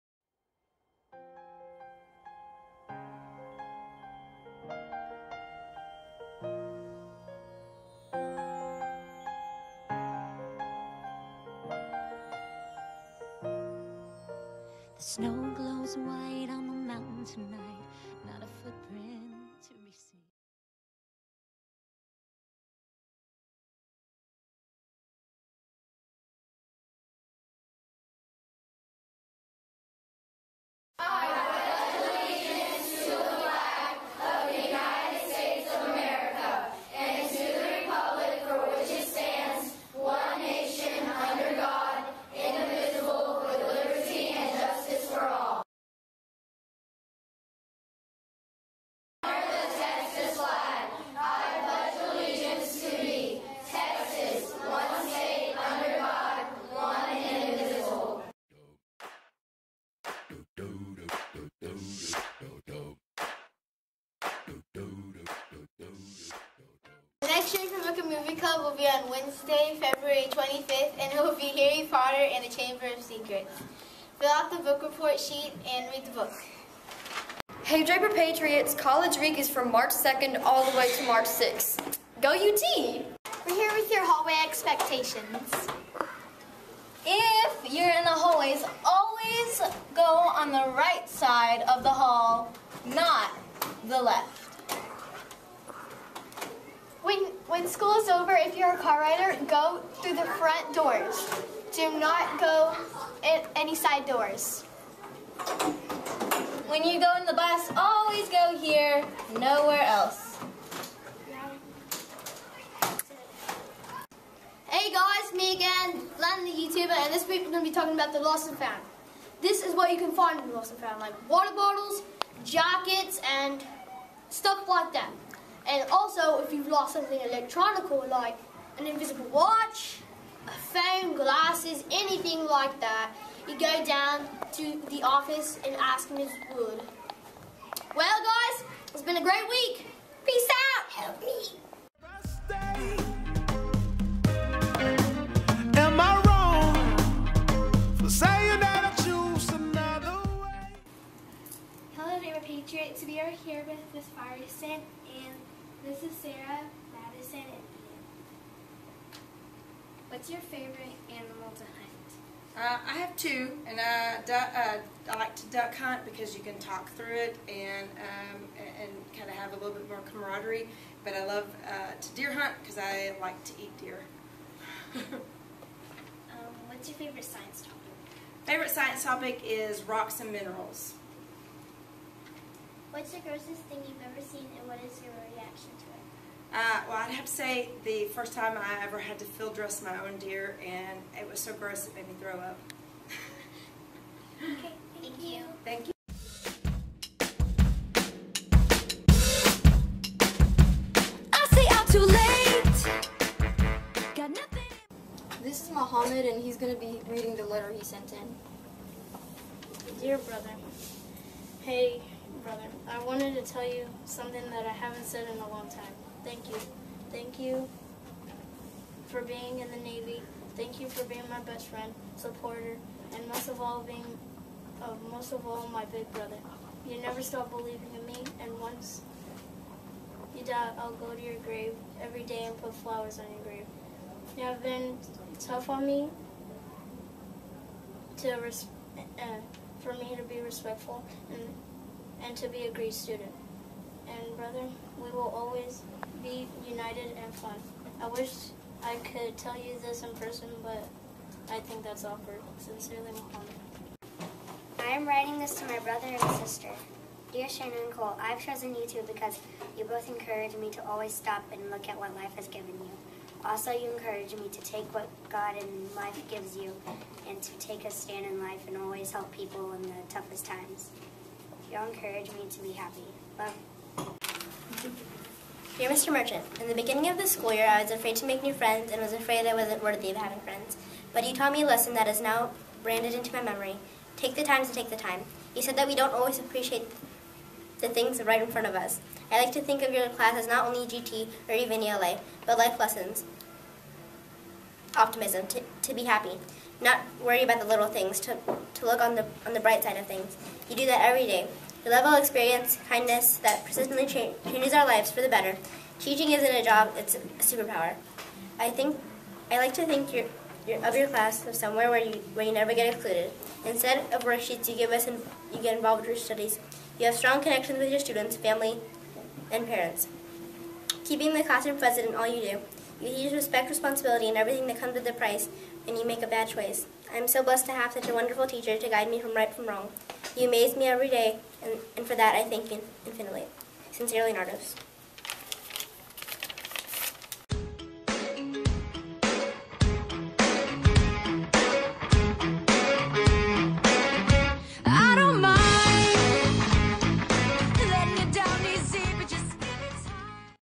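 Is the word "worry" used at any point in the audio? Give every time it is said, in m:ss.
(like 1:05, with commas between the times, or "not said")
4:57.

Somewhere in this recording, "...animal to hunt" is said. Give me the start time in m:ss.
2:41.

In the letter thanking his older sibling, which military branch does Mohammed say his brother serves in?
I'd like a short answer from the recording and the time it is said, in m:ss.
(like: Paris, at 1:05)
Navy, at 3:39.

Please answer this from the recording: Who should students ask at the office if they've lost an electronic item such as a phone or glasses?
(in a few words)
Ms. Wood.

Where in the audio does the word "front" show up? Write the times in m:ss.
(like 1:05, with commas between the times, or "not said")
1:40, 4:48.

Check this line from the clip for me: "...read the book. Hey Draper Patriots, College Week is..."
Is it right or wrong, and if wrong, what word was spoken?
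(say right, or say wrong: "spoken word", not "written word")
right.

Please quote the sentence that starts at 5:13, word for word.
Instead of worksheets you give us, and you get involved with your studies.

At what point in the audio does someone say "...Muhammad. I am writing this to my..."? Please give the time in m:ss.
4:13.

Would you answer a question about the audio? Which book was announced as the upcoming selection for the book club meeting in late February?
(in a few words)
Harry Potter and the Chamber of Secrets.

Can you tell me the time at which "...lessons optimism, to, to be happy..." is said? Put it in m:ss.
4:52.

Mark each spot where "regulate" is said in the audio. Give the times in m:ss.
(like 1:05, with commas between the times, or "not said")
not said.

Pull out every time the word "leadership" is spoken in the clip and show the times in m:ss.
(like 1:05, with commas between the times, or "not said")
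not said.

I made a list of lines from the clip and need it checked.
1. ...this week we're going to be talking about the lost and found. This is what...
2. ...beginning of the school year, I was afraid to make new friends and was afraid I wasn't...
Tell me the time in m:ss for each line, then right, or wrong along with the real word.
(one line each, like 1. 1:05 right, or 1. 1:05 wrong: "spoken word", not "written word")
1. 1:57 right
2. 4:36 right.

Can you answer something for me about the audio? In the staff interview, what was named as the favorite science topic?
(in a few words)
Rocks and minerals.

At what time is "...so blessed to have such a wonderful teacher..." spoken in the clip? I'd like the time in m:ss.
5:27.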